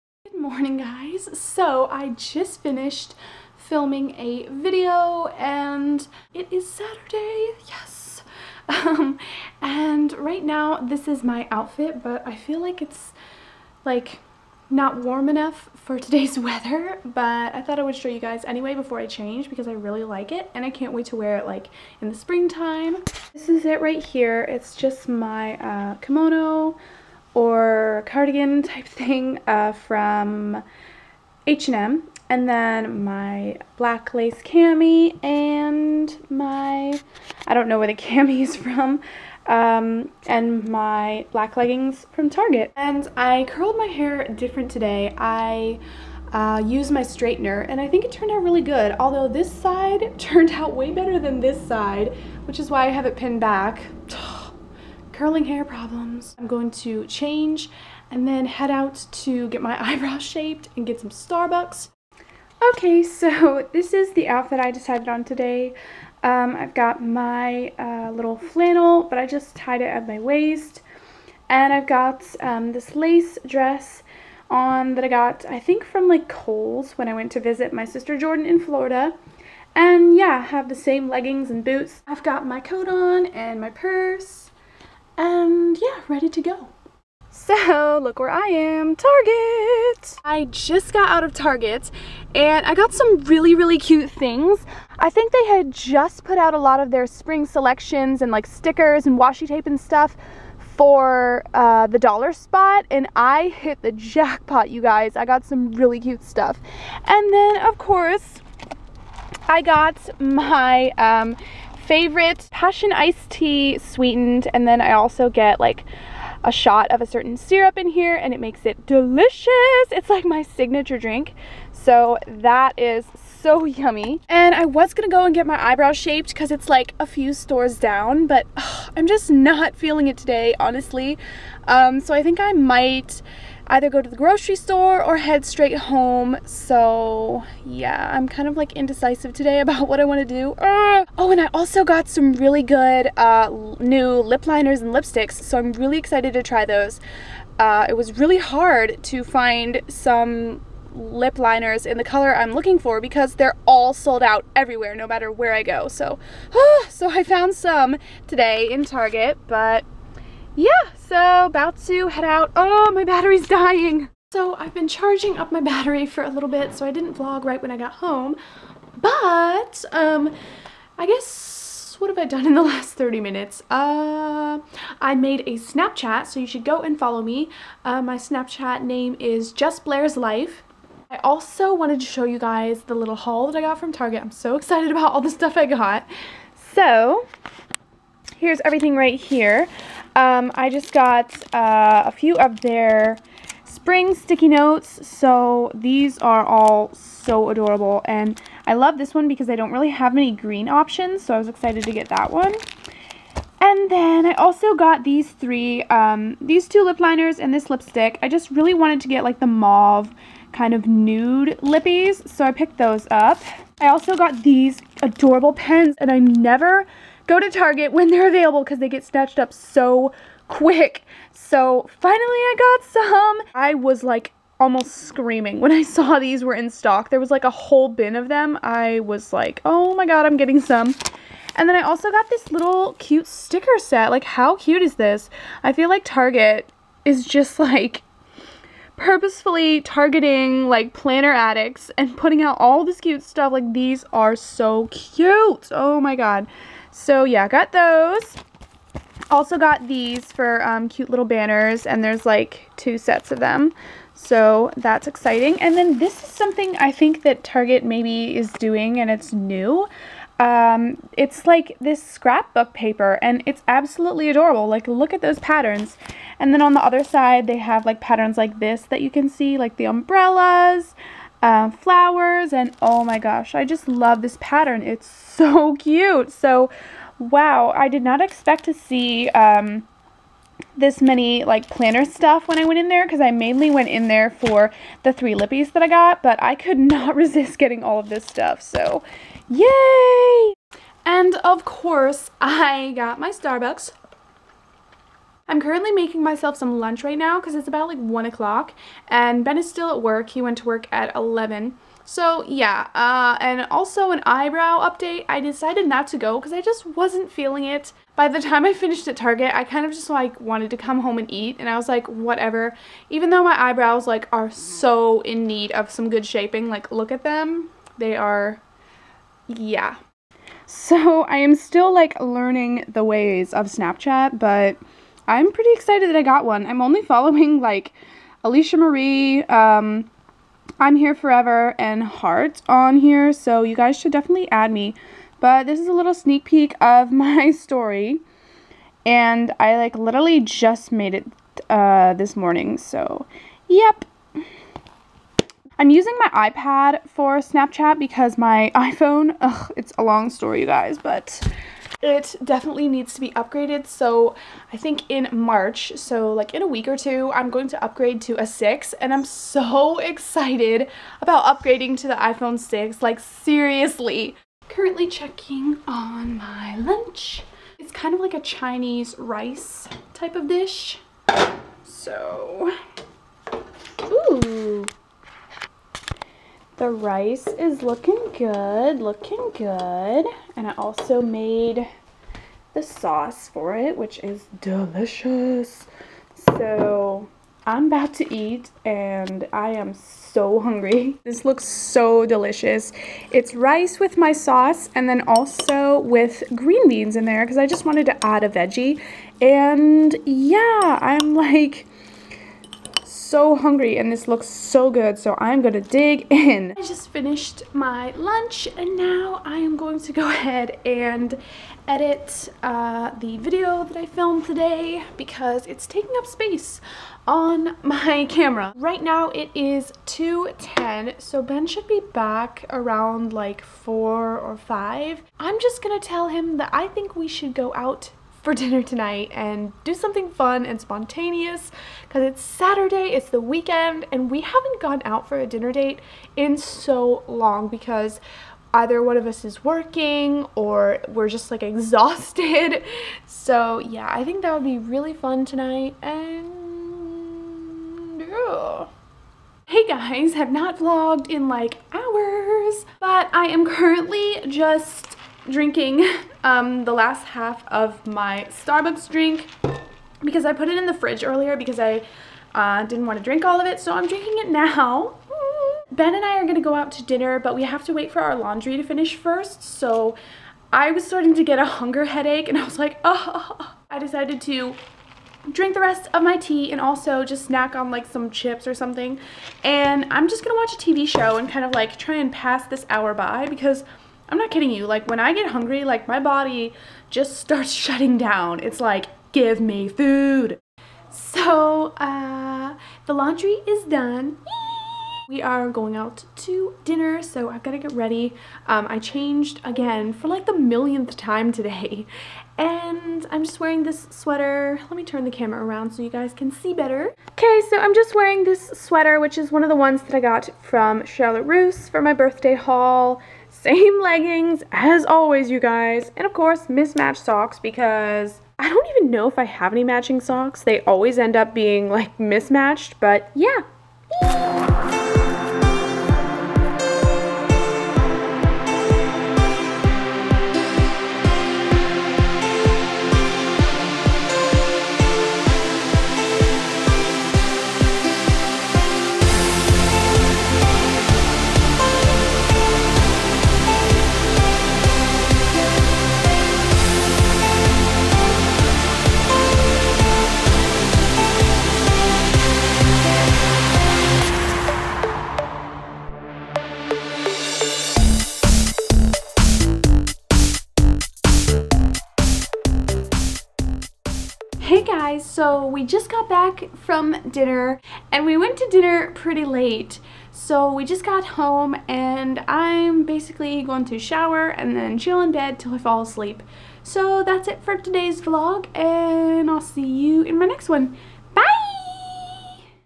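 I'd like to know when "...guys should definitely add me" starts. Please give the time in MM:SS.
05:33.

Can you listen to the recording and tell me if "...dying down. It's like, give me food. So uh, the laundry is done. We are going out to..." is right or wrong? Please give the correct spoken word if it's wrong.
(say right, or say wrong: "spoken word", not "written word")
wrong: "shutting", not "dying".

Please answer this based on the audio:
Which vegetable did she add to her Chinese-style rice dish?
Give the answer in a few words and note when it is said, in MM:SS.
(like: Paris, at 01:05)
Green beans, at 06:36.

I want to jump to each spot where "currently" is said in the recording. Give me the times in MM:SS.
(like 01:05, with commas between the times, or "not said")
04:55, 06:04, 07:33.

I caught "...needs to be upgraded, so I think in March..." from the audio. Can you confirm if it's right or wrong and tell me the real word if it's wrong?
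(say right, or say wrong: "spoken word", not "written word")
right.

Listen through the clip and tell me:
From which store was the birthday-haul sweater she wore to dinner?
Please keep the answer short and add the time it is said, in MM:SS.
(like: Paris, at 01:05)
Charlotte Russe, at 08:31.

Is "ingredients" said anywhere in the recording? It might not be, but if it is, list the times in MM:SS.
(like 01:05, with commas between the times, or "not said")
not said.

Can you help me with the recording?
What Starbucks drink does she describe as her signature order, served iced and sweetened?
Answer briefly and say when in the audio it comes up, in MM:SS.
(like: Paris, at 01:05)
Passion iced tea, at 01:52.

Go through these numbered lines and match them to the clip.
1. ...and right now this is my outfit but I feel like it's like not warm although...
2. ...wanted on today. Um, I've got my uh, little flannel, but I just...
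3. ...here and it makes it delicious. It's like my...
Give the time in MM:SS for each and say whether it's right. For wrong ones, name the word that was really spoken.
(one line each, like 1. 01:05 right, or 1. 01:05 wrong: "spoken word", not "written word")
1. 00:09 wrong: "enough", not "although"
2. 01:04 wrong: "decided", not "wanted"
3. 01:57 right.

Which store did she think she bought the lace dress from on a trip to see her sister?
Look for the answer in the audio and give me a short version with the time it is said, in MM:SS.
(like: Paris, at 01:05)
Kohl's, at 01:16.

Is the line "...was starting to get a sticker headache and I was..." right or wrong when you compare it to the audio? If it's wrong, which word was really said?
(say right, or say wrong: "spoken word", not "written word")
wrong: "hunger", not "sticker".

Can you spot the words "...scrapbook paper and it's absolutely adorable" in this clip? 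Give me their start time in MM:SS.
04:22.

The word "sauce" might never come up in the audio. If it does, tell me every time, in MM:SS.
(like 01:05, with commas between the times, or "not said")
06:22, 06:34.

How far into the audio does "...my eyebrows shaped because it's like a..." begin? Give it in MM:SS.
02:05.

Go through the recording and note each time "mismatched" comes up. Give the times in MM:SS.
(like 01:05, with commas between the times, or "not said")
08:36, 08:42.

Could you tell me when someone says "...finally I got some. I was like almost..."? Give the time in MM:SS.
03:41.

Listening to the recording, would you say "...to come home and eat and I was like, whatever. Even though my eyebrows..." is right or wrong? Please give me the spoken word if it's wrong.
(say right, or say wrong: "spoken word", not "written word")
right.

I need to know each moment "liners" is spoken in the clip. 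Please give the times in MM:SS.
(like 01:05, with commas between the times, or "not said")
02:24, 02:31, 03:26.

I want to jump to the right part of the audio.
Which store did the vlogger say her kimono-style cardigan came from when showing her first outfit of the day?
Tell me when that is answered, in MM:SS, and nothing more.
00:31.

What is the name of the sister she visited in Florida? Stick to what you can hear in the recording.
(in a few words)
Jordan.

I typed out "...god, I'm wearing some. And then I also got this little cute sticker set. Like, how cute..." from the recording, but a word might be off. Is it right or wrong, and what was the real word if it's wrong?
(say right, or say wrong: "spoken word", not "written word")
wrong: "getting", not "wearing".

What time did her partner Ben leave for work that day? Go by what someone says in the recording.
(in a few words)
11.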